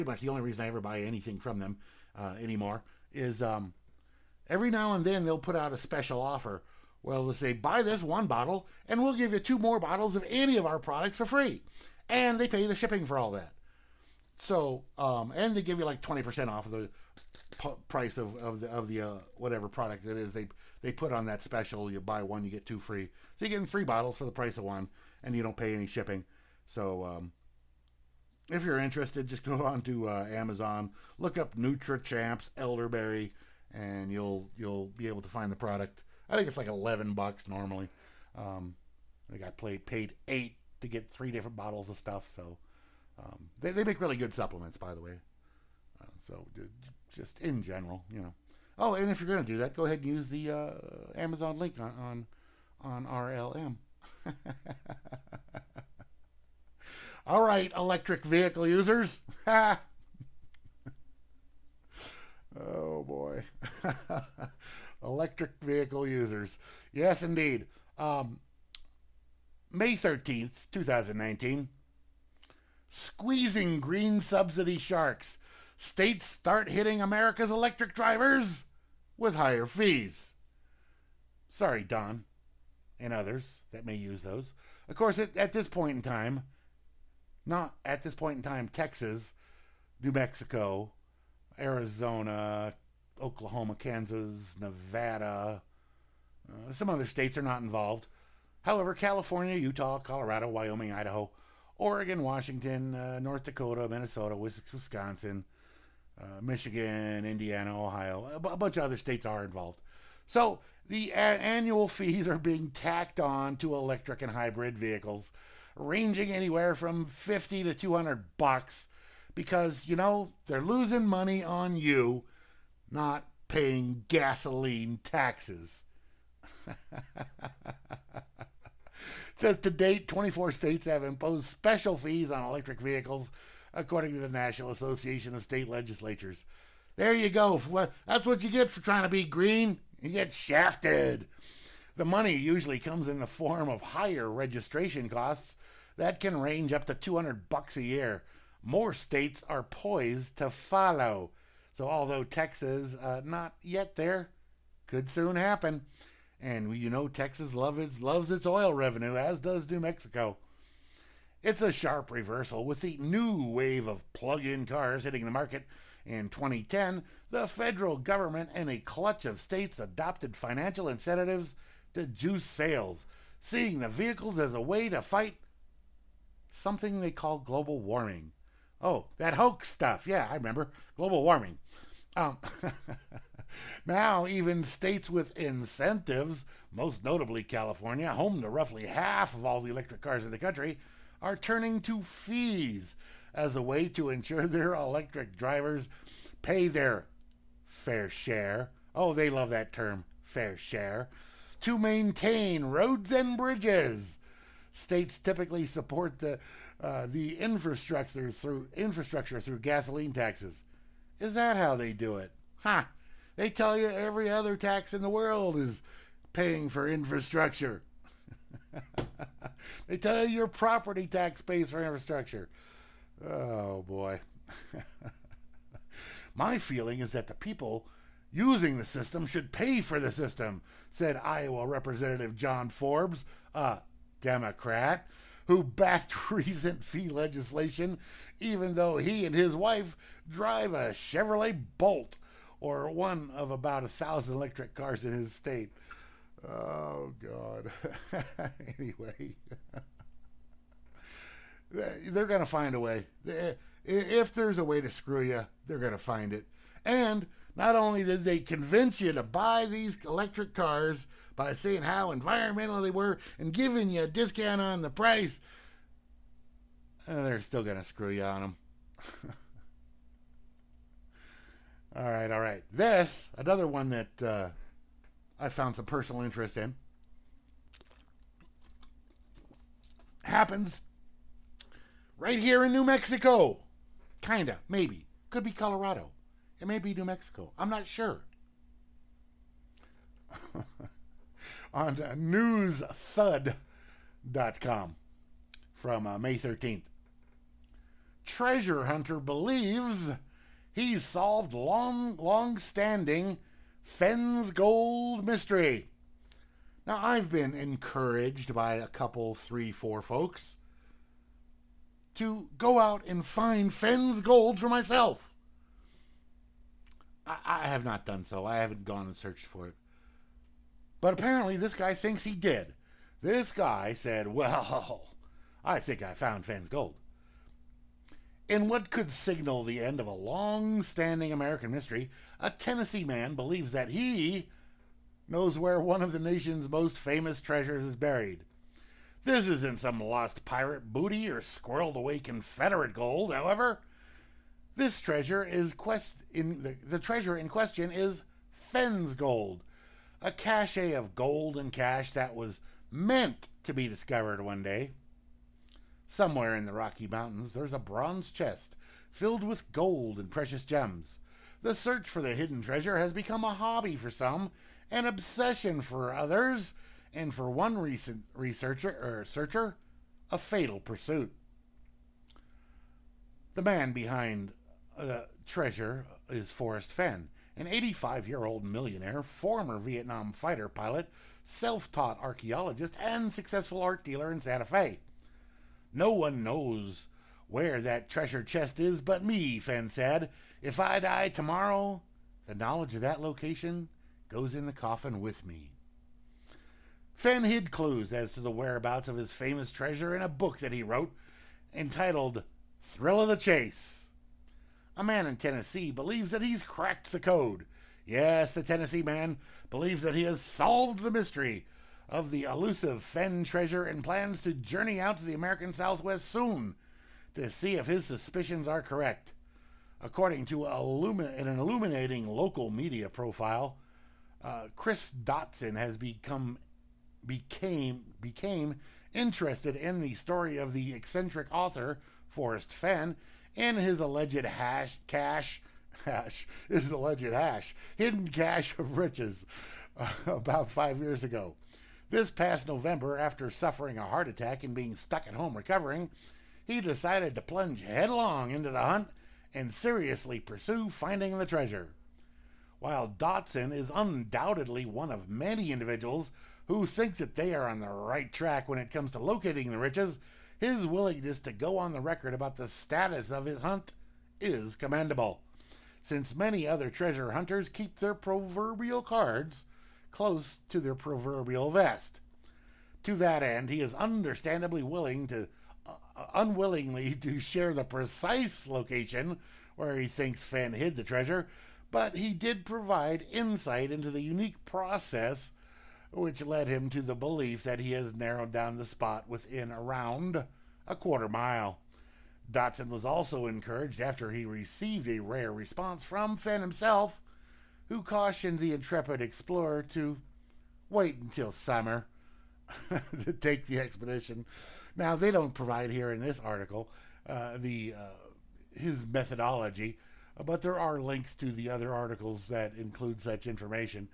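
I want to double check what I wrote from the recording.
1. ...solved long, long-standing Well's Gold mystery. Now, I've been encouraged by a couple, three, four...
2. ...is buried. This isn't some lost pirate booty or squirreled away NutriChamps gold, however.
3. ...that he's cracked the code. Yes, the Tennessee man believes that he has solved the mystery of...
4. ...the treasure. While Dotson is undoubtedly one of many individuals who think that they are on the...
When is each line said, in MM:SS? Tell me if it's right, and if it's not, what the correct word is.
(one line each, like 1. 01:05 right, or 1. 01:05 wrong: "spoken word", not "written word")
1. 05:01 wrong: "Fenn", not "Well"
2. 05:37 wrong: "Confederate", not "NutriChamps"
3. 06:46 right
4. 07:31 right.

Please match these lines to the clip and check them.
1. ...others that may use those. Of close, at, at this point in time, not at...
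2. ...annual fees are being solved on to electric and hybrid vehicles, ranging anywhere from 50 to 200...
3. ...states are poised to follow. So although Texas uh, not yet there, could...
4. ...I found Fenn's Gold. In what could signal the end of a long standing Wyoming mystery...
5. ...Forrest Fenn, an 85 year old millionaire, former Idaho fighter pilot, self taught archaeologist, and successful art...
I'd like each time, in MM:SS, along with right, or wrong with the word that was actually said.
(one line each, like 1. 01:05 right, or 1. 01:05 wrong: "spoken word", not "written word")
1. 01:23 wrong: "course", not "close"
2. 01:51 wrong: "tacked", not "solved"
3. 02:28 right
4. 05:26 wrong: "American", not "Wyoming"
5. 06:16 wrong: "Vietnam", not "Idaho".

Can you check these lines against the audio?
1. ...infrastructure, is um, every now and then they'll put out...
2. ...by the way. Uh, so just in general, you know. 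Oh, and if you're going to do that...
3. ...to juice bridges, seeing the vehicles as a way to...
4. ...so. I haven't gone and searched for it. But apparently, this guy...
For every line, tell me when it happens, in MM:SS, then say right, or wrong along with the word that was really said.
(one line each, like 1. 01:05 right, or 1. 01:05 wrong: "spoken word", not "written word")
1. 00:02 wrong: "anymore", not "infrastructure"
2. 00:44 right
3. 02:51 wrong: "sales", not "bridges"
4. 05:18 right.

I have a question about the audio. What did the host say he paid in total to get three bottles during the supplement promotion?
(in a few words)
8 dollars.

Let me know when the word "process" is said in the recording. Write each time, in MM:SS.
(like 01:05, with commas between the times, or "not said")
08:04.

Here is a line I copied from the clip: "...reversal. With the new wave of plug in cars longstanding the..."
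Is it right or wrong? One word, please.
wrong.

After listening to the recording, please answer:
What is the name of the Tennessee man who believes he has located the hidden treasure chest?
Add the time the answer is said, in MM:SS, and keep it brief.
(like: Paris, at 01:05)
Chris Dotson, at 07:04.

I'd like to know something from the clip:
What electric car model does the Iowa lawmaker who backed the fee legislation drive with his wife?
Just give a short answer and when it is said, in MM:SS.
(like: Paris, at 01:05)
Chevrolet Bolt, at 04:00.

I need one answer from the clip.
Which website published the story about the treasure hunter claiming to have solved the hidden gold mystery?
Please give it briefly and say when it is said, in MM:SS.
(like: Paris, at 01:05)
newsthud.com, at 04:52.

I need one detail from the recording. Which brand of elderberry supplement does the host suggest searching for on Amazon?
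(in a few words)
NutriChamps.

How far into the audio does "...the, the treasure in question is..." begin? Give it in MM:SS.
05:46.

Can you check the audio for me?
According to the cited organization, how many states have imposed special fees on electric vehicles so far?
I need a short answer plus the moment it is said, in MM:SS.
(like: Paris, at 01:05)
24, at 02:10.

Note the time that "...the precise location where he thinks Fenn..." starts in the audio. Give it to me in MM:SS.
07:57.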